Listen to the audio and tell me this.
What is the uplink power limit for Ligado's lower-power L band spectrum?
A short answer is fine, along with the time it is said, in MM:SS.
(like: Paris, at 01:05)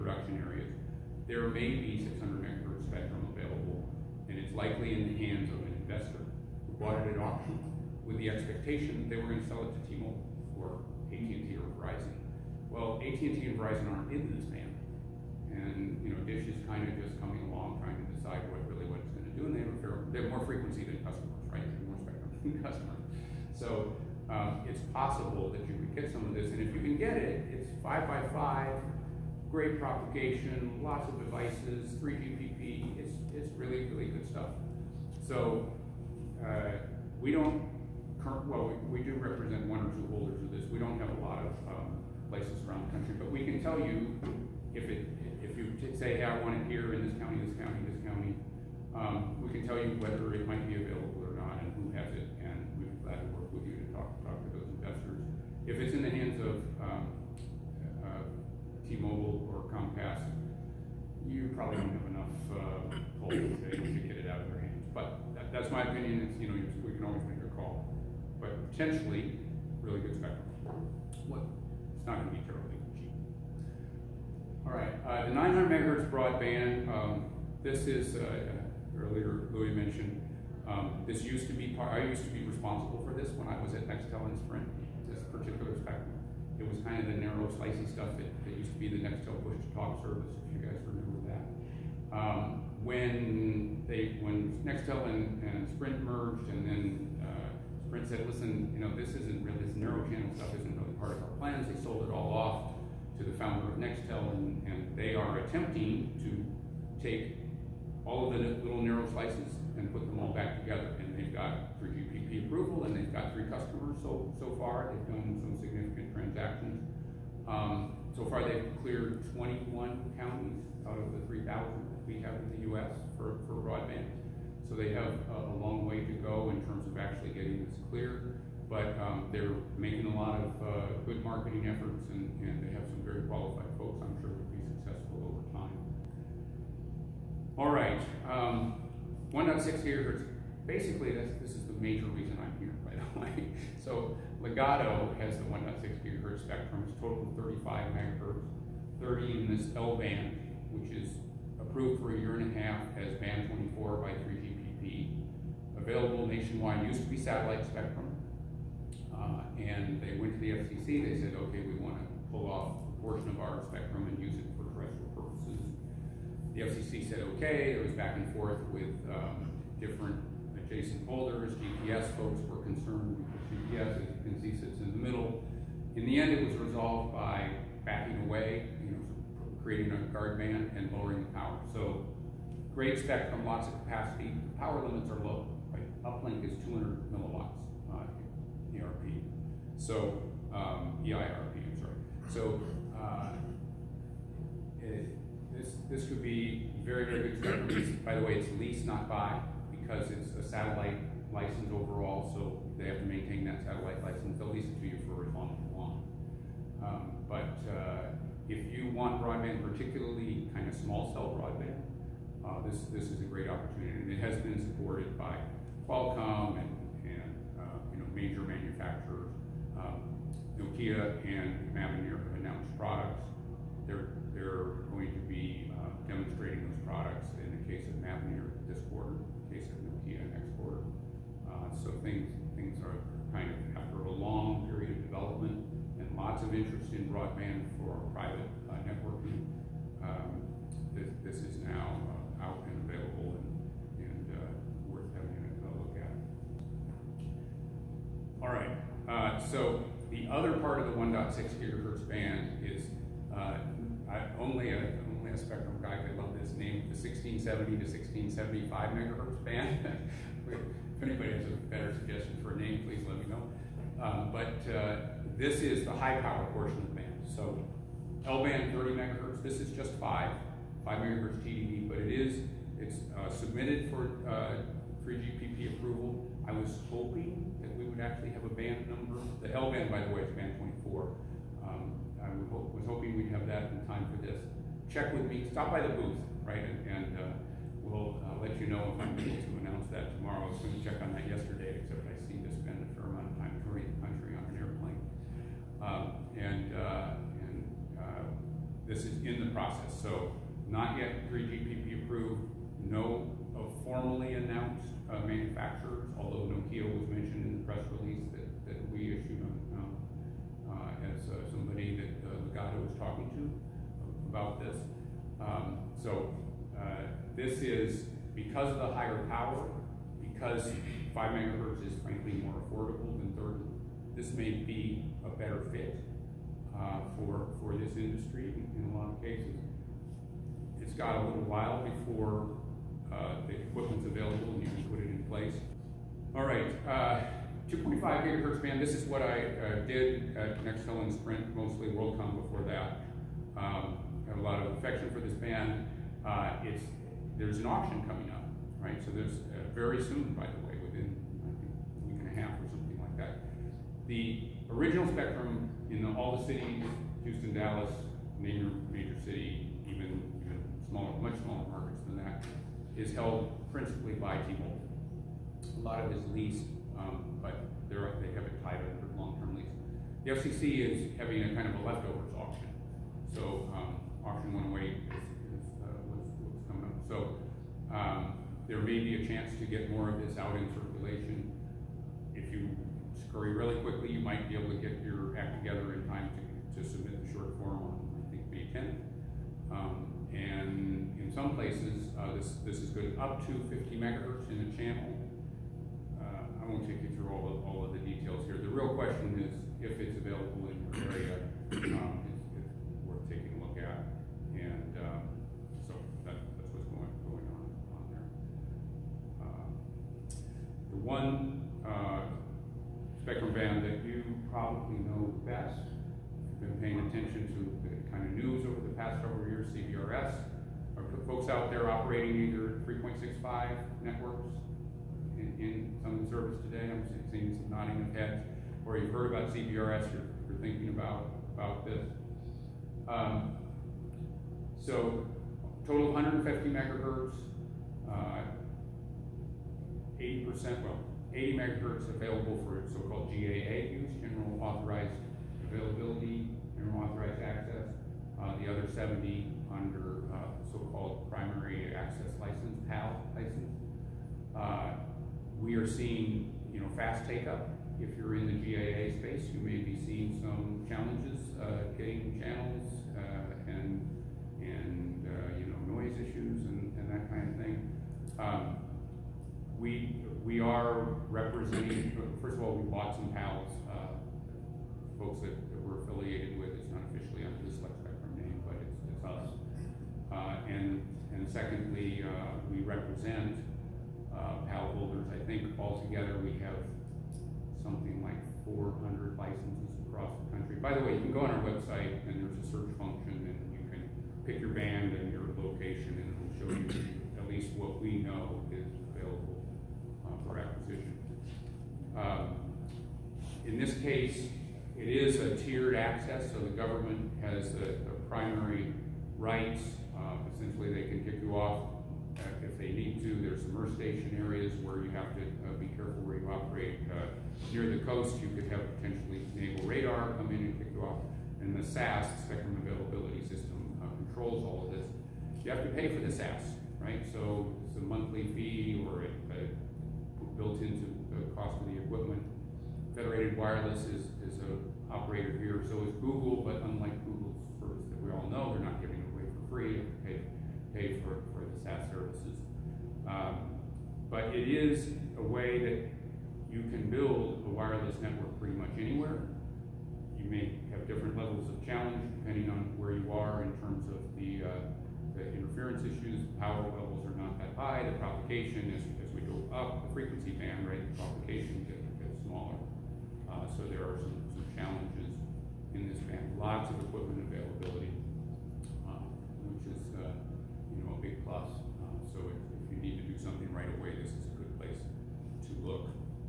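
200 milliwatts, at 03:06.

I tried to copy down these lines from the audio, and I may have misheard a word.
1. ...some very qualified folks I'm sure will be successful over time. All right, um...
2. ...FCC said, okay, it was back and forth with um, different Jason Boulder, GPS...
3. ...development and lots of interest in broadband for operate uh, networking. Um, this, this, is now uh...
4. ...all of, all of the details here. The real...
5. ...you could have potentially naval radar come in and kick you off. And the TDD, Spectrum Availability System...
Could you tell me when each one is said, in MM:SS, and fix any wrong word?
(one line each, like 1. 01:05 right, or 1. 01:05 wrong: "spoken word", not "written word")
1. 02:12 right
2. 02:46 right
3. 03:55 wrong: "private", not "operate"
4. 06:37 right
5. 08:38 wrong: "SAS", not "TDD".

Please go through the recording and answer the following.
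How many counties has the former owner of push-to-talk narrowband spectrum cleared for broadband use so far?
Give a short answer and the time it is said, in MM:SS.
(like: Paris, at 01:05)
21, at 01:59.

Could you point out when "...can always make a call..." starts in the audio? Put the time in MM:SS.
01:06.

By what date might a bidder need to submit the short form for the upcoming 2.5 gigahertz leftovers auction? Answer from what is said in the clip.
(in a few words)
May 10.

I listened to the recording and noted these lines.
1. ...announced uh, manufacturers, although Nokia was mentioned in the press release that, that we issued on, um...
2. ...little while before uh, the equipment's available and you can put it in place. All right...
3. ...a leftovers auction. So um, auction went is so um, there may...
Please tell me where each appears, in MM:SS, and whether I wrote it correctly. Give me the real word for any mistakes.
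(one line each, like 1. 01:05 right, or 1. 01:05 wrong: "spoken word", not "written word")
1. 05:04 right
2. 05:31 right
3. 06:11 right.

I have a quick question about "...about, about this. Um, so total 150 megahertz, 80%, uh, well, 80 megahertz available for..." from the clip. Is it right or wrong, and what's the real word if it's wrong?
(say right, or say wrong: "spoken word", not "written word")
right.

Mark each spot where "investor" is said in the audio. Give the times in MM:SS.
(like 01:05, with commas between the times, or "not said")
00:05, 00:54.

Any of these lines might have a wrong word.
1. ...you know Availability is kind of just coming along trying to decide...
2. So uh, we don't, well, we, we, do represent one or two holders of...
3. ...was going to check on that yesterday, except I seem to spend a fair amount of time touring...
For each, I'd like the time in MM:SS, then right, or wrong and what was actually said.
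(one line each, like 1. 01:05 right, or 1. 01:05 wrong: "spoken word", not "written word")
1. 00:16 wrong: "Dish", not "Availability"
2. 00:35 right
3. 04:50 right.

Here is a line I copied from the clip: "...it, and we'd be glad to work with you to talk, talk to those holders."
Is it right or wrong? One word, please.
wrong.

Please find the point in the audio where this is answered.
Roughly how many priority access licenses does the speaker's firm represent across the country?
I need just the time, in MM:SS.
08:08.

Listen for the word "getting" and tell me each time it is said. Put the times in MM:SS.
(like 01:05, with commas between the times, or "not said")
02:07, 07:41.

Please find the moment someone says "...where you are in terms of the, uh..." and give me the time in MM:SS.
09:12.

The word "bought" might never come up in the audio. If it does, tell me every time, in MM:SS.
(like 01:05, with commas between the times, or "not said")
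00:06, 07:52.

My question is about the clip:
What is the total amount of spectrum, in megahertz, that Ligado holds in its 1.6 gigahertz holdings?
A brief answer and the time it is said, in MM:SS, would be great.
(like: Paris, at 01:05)
35 megahertz, at 02:27.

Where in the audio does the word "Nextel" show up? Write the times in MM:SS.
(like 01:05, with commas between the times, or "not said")
01:23, 01:29, 01:34, 01:43, 05:40.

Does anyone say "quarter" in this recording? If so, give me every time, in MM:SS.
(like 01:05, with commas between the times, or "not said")
03:48.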